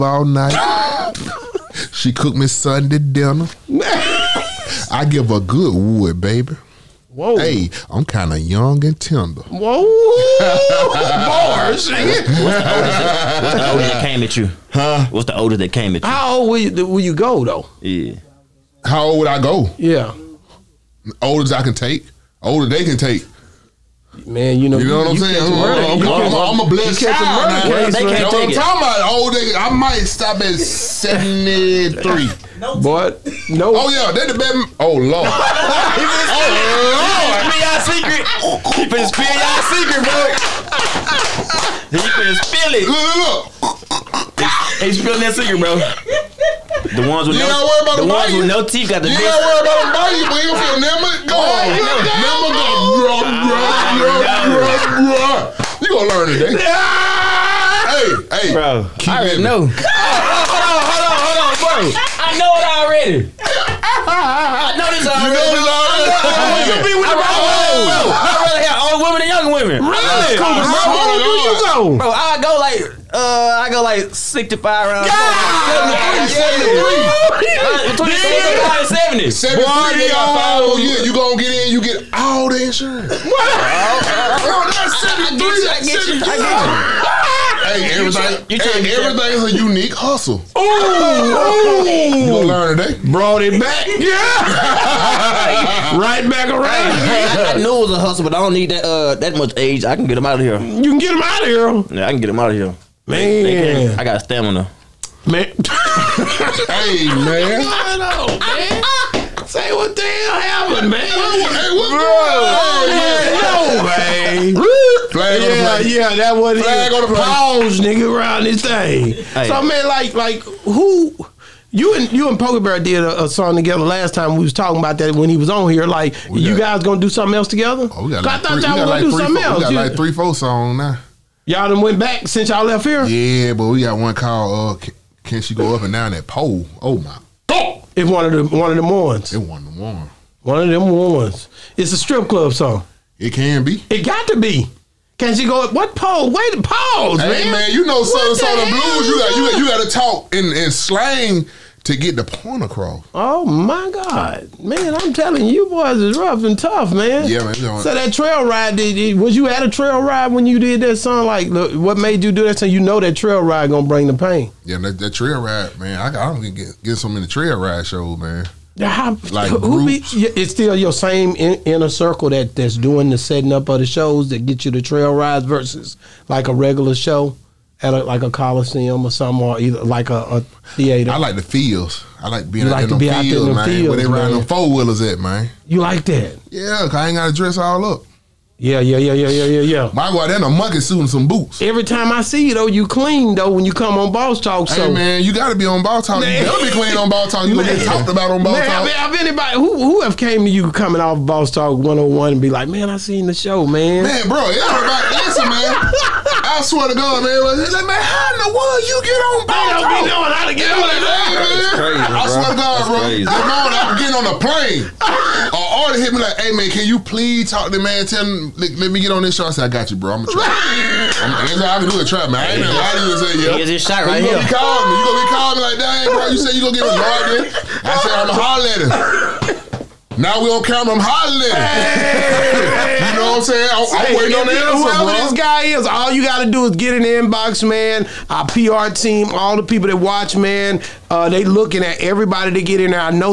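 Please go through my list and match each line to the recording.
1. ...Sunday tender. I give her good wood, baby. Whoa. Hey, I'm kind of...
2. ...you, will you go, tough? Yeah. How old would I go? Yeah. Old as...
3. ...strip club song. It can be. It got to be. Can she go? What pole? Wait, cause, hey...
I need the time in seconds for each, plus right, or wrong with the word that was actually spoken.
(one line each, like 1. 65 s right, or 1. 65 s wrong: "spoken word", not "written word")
1. 2 s wrong: "dinner", not "tender"
2. 16 s wrong: "though", not "tough"
3. 141 s wrong: "pause", not "cause".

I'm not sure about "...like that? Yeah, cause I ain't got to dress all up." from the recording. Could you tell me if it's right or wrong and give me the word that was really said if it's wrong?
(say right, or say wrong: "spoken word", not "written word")
right.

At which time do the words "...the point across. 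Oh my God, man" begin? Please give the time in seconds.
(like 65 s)
152 s.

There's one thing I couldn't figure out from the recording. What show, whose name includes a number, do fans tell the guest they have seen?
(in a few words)
Boss Talk 101.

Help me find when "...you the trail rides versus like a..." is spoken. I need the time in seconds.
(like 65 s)
174 s.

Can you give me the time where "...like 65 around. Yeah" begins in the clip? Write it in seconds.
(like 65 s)
73 s.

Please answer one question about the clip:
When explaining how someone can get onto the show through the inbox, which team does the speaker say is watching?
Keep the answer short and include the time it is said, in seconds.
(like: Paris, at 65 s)
PR team, at 238 s.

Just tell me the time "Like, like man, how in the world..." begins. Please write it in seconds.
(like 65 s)
207 s.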